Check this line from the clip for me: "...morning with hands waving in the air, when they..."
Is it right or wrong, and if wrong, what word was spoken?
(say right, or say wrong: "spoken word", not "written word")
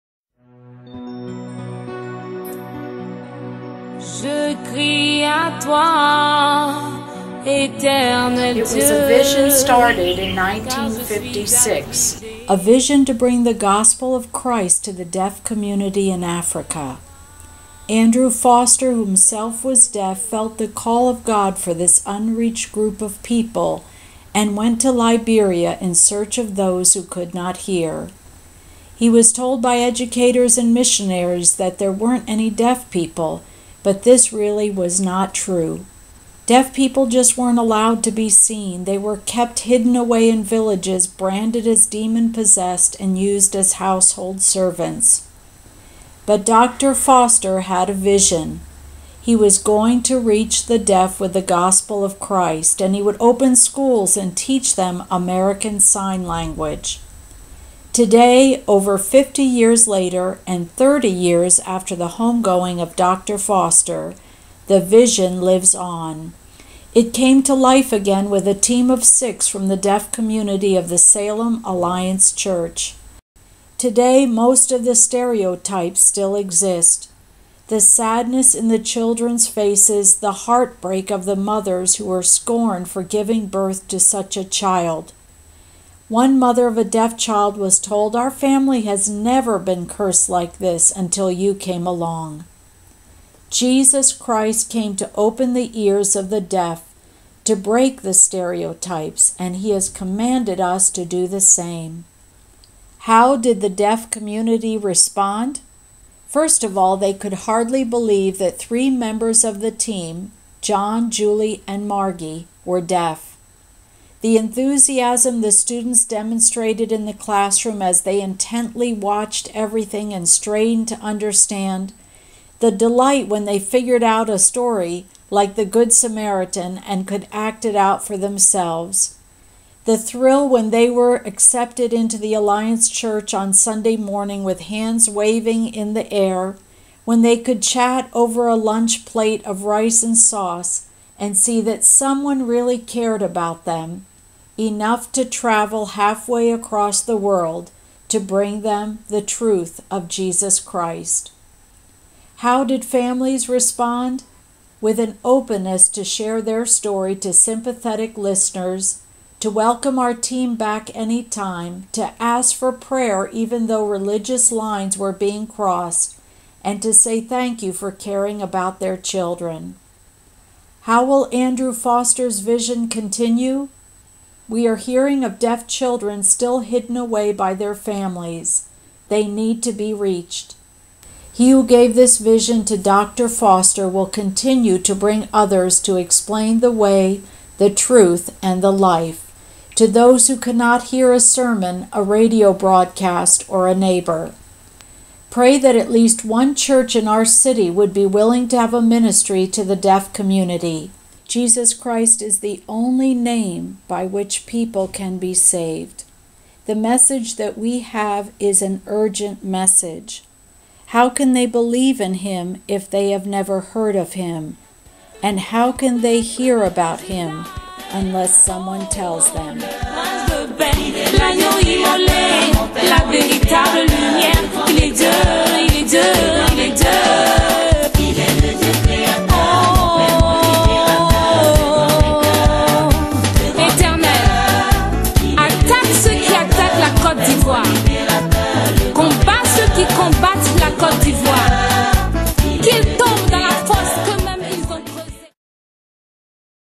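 right.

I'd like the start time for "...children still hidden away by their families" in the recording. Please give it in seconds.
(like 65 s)
175 s.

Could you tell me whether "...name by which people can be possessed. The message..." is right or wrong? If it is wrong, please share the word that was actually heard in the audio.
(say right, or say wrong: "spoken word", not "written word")
wrong: "saved", not "possessed".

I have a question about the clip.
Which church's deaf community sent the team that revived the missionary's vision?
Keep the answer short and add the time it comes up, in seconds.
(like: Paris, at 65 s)
Salem Alliance Church, at 70 s.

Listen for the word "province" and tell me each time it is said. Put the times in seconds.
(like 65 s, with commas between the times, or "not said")
not said.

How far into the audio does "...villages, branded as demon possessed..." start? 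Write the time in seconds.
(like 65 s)
40 s.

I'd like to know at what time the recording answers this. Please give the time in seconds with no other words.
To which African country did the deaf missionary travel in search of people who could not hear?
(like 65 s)
24 s.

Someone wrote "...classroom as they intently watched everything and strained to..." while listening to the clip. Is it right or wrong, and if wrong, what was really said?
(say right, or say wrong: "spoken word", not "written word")
right.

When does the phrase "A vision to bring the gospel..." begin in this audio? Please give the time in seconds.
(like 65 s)
12 s.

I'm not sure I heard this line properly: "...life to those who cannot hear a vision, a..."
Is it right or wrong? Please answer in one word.
wrong.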